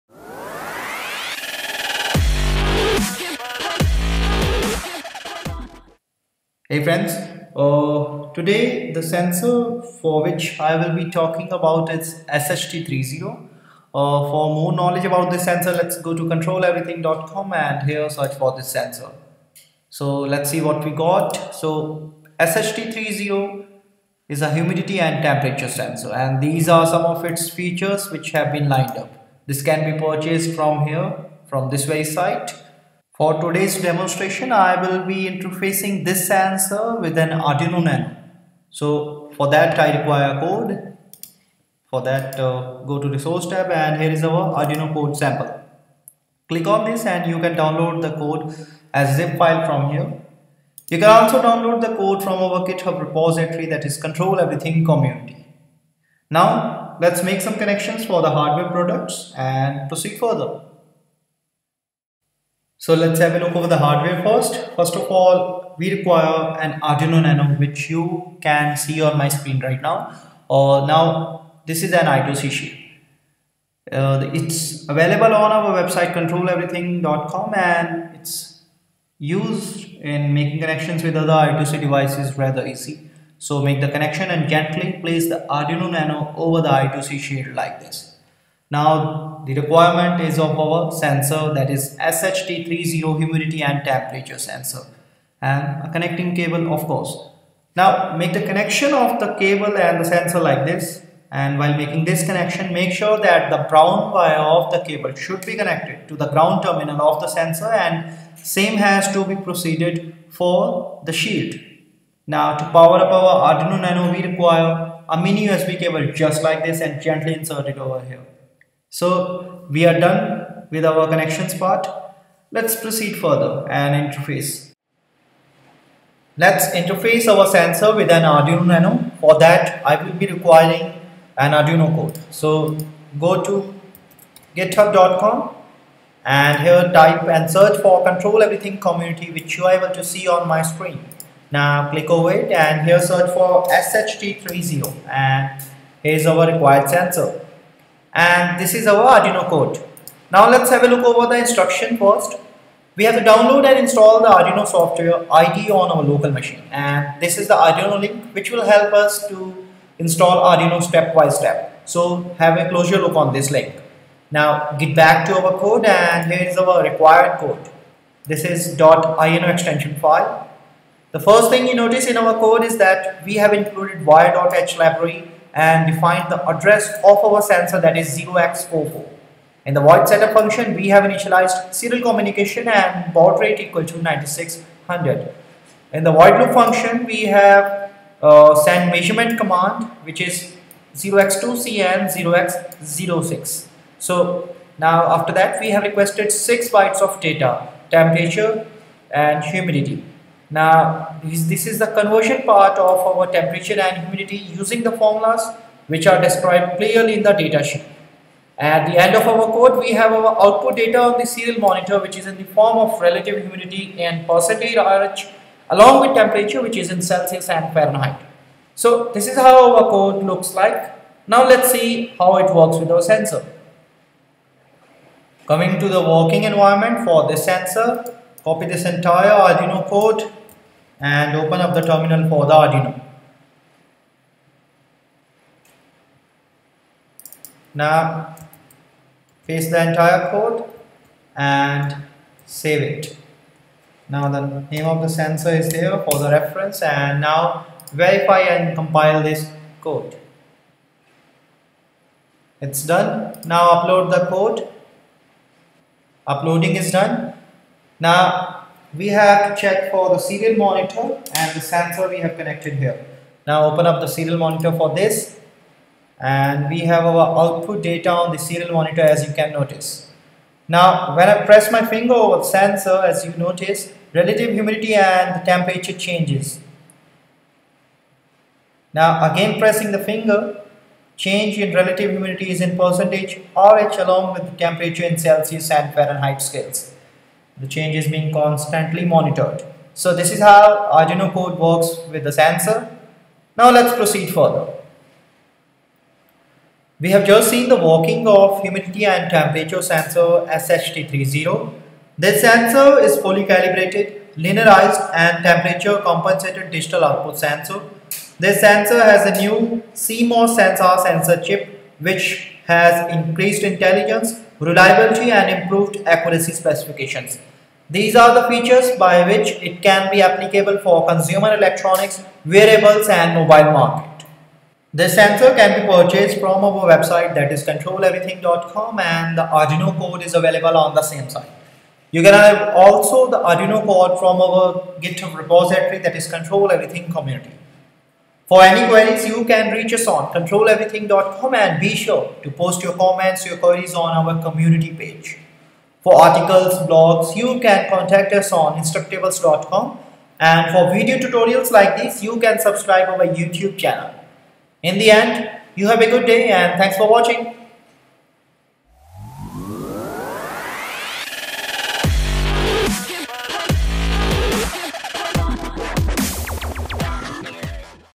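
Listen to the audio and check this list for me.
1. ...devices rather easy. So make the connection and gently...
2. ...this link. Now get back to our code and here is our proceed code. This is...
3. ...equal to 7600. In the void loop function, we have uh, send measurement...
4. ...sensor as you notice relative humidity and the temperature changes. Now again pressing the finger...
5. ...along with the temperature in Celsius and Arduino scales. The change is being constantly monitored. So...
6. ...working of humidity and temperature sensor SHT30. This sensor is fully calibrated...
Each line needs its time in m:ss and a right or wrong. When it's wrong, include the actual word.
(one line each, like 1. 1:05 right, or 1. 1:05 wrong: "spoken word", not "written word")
1. 1:21 right
2. 2:43 wrong: "required", not "proceed"
3. 3:03 wrong: "9600", not "7600"
4. 4:32 right
5. 4:43 wrong: "Fahrenheit", not "Arduino"
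6. 4:57 right.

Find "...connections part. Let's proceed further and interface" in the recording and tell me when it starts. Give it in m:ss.
2:01.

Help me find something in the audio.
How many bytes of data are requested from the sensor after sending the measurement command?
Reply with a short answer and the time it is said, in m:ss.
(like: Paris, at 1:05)
6, at 3:16.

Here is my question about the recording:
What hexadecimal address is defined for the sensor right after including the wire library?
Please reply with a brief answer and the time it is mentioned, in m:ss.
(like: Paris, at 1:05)
0x44, at 2:58.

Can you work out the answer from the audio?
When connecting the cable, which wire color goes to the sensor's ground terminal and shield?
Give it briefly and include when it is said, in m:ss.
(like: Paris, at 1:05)
brown, at 1:43.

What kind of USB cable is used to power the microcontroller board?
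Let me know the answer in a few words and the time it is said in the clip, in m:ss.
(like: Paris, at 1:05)
mini USB, at 1:55.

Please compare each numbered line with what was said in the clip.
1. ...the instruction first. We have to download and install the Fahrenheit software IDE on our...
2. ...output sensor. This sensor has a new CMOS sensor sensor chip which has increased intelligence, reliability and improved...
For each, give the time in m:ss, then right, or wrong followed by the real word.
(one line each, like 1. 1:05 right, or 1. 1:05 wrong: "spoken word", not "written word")
1. 2:31 wrong: "Arduino", not "Fahrenheit"
2. 5:07 right.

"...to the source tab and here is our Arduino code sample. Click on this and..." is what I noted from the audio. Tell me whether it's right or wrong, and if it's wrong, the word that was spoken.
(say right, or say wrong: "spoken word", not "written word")
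right.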